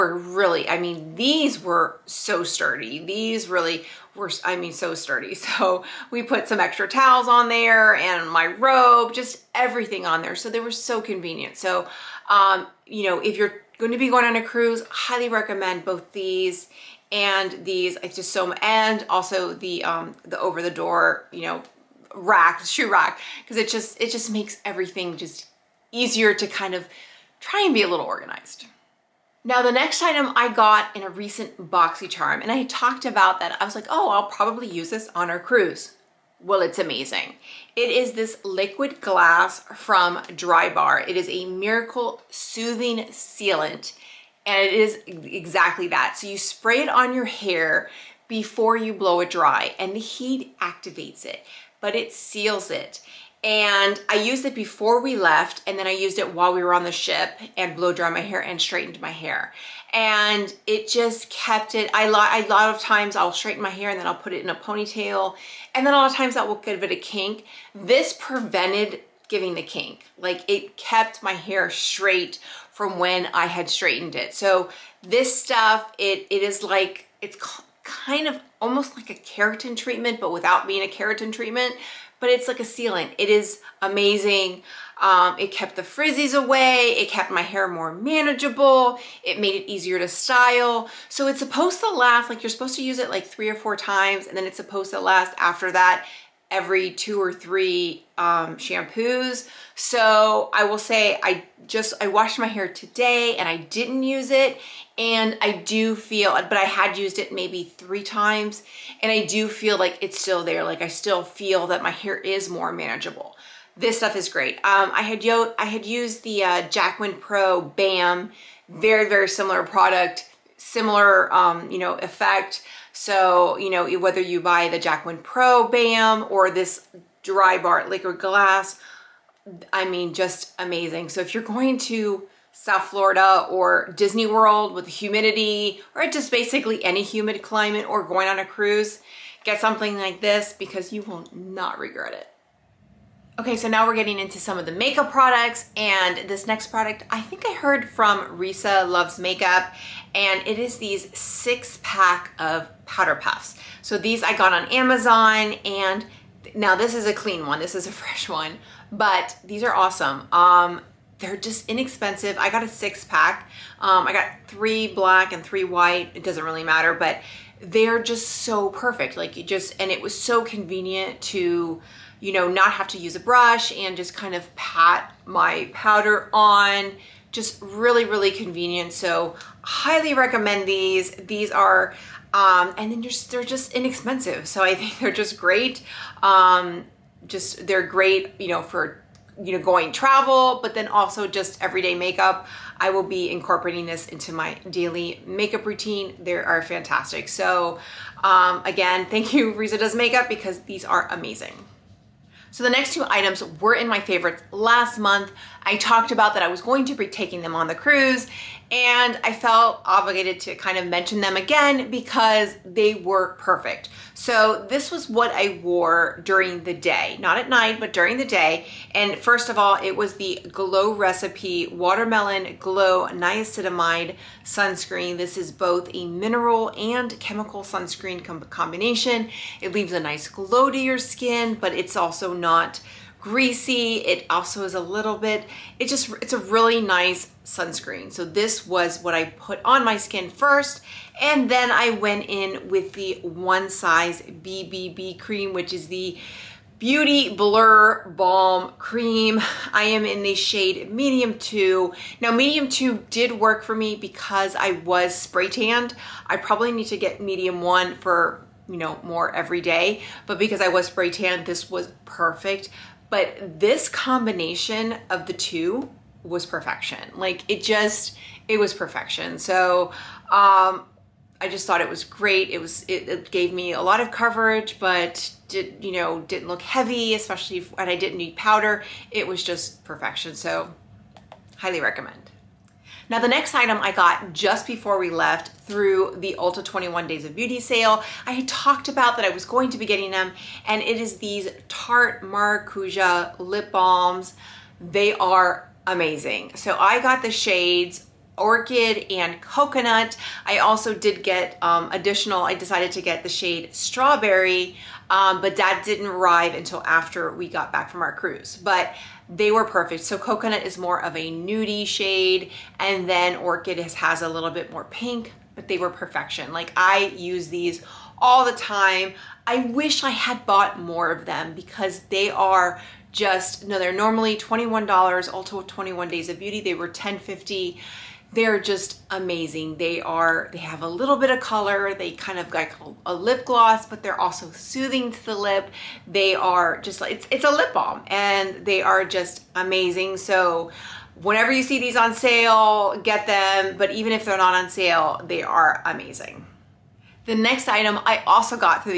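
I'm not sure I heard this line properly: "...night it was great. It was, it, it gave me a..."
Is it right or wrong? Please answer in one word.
wrong.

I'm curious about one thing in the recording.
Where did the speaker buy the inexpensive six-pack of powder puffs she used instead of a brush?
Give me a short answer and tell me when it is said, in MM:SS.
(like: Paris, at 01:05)
Amazon, at 02:34.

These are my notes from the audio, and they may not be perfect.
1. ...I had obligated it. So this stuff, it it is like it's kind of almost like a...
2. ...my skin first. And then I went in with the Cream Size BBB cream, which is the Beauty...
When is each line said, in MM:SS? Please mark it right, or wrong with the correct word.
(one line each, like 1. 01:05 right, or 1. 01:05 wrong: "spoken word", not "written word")
1. 01:13 wrong: "straightened", not "obligated"
2. 03:59 wrong: "One", not "Cream".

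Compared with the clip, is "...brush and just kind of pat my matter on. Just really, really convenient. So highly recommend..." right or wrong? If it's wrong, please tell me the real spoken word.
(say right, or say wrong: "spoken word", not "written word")
wrong: "powder", not "matter".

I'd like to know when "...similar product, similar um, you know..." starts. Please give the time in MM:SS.
01:59.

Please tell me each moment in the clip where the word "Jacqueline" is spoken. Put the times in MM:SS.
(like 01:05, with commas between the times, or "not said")
02:04.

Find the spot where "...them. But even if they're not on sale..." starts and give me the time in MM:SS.
05:43.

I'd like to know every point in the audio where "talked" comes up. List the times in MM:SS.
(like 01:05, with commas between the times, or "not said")
00:32, 03:25, 04:48.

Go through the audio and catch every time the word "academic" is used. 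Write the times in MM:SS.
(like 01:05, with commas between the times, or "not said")
not said.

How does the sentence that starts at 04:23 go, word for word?
But this combination of the two was perfection.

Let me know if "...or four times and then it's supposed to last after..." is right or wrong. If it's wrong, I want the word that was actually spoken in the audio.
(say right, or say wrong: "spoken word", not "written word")
right.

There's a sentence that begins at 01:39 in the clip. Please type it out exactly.
So I will say I just, I washed my hair today and I didn't use it.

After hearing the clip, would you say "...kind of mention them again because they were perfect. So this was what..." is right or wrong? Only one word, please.
right.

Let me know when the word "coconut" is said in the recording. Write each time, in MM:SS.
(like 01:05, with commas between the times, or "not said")
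04:59, 05:10.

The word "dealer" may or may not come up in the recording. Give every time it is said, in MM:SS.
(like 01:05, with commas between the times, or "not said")
not said.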